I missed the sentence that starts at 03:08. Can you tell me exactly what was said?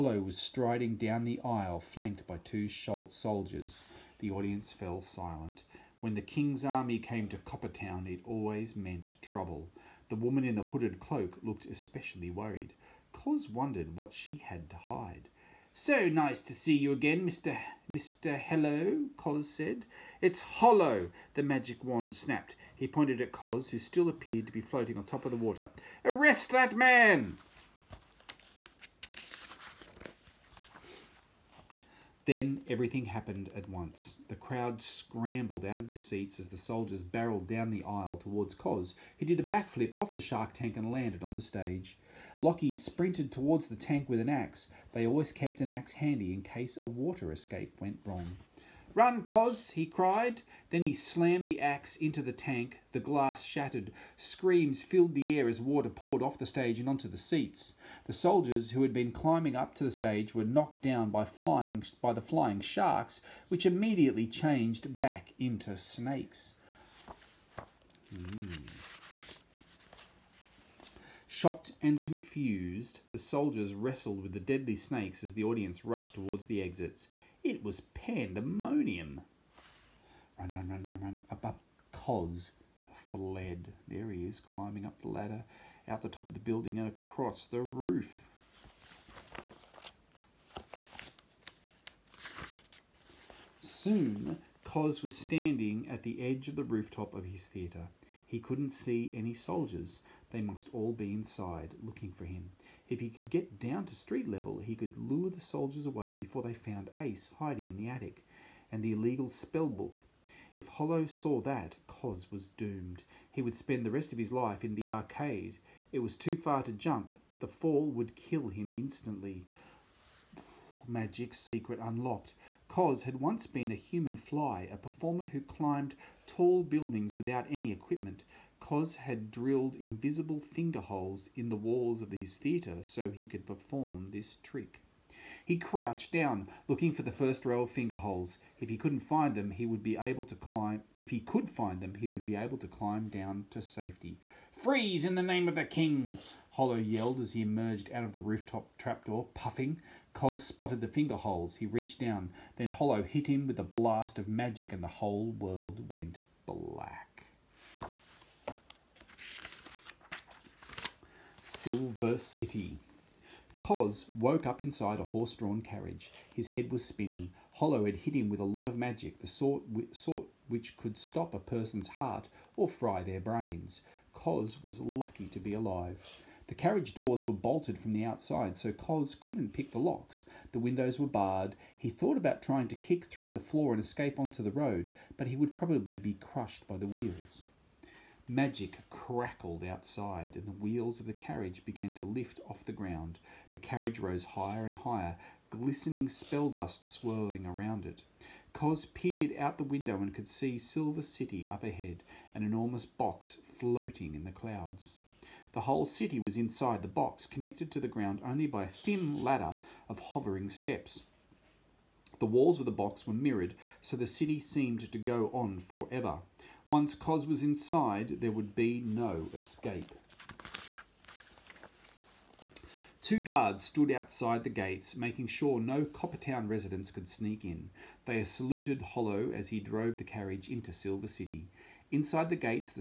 Magic crackled outside, and the wheels of the carriage began to lift off the ground.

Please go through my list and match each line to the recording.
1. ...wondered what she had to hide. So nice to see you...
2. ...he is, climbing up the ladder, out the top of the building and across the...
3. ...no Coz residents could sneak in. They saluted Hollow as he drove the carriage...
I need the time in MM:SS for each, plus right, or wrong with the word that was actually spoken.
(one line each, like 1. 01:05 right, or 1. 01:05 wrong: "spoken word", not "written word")
1. 00:13 right
2. 01:24 right
3. 03:45 wrong: "Coppertown", not "Coz".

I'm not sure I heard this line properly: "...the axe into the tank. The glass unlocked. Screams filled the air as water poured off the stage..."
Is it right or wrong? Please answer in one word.
wrong.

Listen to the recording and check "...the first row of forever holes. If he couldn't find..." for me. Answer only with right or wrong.
wrong.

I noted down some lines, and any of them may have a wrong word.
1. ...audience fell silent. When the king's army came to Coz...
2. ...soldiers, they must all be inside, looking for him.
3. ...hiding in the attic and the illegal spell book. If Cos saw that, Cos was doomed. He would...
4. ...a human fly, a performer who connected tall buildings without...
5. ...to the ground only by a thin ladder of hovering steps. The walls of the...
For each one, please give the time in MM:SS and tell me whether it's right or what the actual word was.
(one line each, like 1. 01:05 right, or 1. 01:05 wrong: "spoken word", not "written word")
1. 00:04 wrong: "Coppertown", not "Coz"
2. 01:39 right
3. 01:47 wrong: "Hollow", not "Cos"
4. 02:03 wrong: "climbed", not "connected"
5. 03:27 right.